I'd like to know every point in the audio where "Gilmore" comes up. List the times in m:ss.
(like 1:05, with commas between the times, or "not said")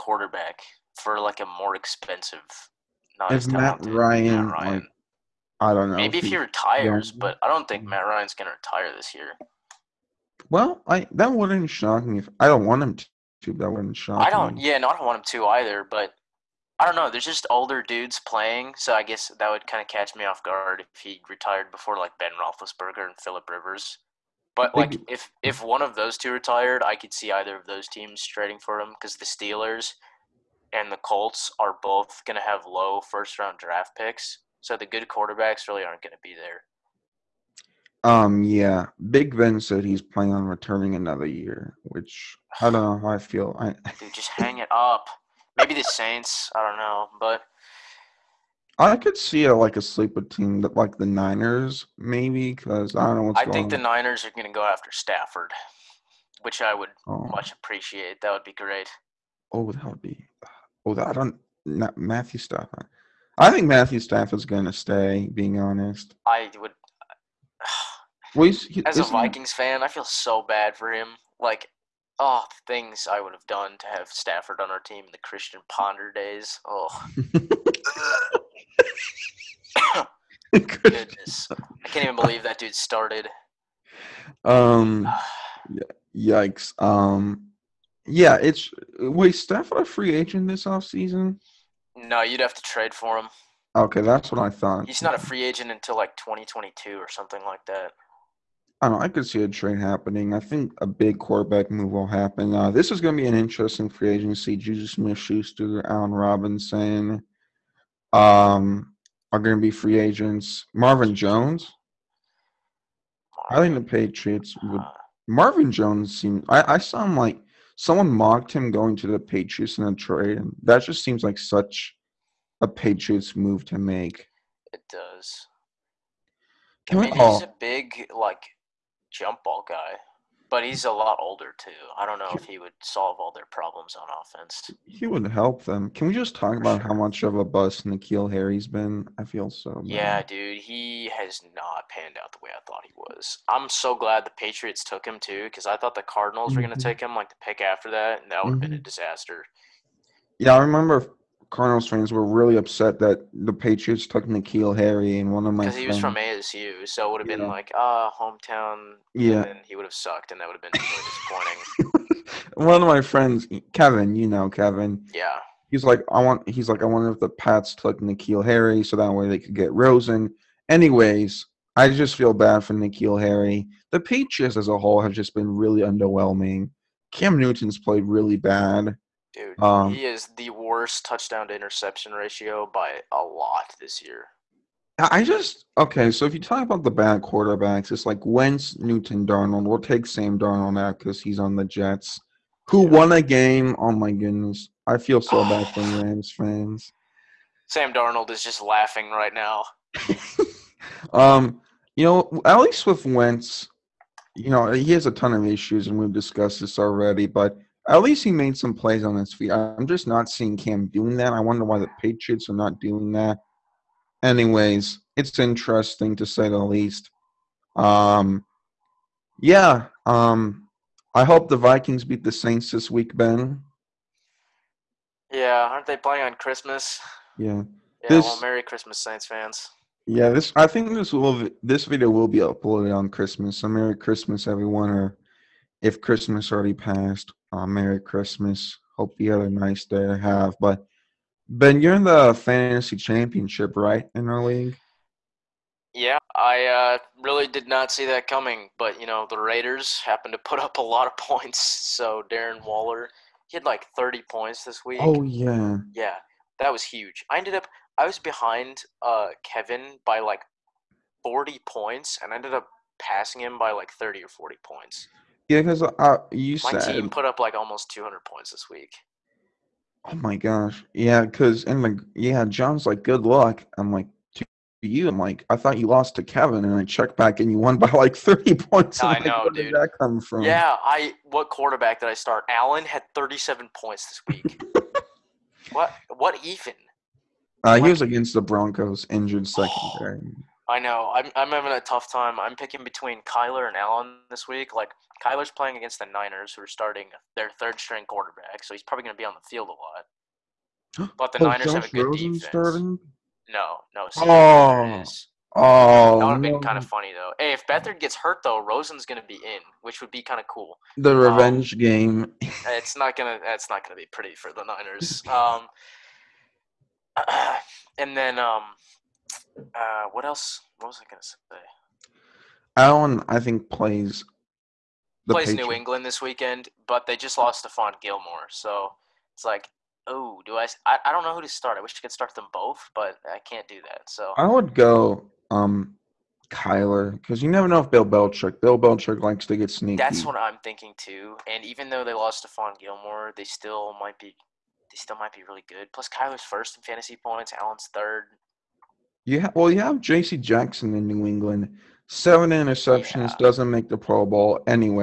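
5:28, 5:42.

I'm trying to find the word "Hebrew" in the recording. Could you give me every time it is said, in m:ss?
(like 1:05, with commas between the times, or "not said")
not said.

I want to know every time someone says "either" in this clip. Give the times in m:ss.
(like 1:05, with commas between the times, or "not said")
0:15, 0:27.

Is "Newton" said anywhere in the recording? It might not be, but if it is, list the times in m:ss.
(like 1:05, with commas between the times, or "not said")
2:57, 3:08.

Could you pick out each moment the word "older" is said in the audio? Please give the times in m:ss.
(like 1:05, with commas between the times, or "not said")
0:17, 2:11.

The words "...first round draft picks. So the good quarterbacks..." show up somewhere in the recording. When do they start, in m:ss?
0:33.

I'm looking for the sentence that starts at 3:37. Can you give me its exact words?
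Um, yeah, um, I hope the Vikings beat the Saints this week, Ben.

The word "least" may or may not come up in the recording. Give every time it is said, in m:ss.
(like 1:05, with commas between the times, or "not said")
3:22, 3:28, 3:36.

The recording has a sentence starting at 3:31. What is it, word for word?
I wonder why the Patriots are not doing that.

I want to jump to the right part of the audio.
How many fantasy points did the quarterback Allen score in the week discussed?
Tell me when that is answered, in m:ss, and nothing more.
4:43.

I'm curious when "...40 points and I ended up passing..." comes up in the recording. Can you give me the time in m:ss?
4:21.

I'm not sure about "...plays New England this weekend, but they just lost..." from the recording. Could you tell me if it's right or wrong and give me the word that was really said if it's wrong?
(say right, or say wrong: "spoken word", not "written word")
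right.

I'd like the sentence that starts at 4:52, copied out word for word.
I'm picking between Kyler and Allen this week.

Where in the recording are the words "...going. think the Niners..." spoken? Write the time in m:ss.
0:53.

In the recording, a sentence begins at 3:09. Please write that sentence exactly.
We'll take Sam Darnold now because he's on the Jets, who yeah.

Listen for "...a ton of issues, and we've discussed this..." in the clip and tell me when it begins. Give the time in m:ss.
3:25.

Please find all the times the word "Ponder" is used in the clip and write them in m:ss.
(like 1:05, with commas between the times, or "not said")
1:15.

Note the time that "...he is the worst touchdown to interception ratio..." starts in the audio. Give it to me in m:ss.
2:59.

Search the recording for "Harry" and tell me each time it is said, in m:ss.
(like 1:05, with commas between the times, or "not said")
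2:18, 2:34, 2:48, 2:53.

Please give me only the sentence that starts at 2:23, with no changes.
I'm so glad the Patriots took him too, because I thought the Cardinals mm-hmm.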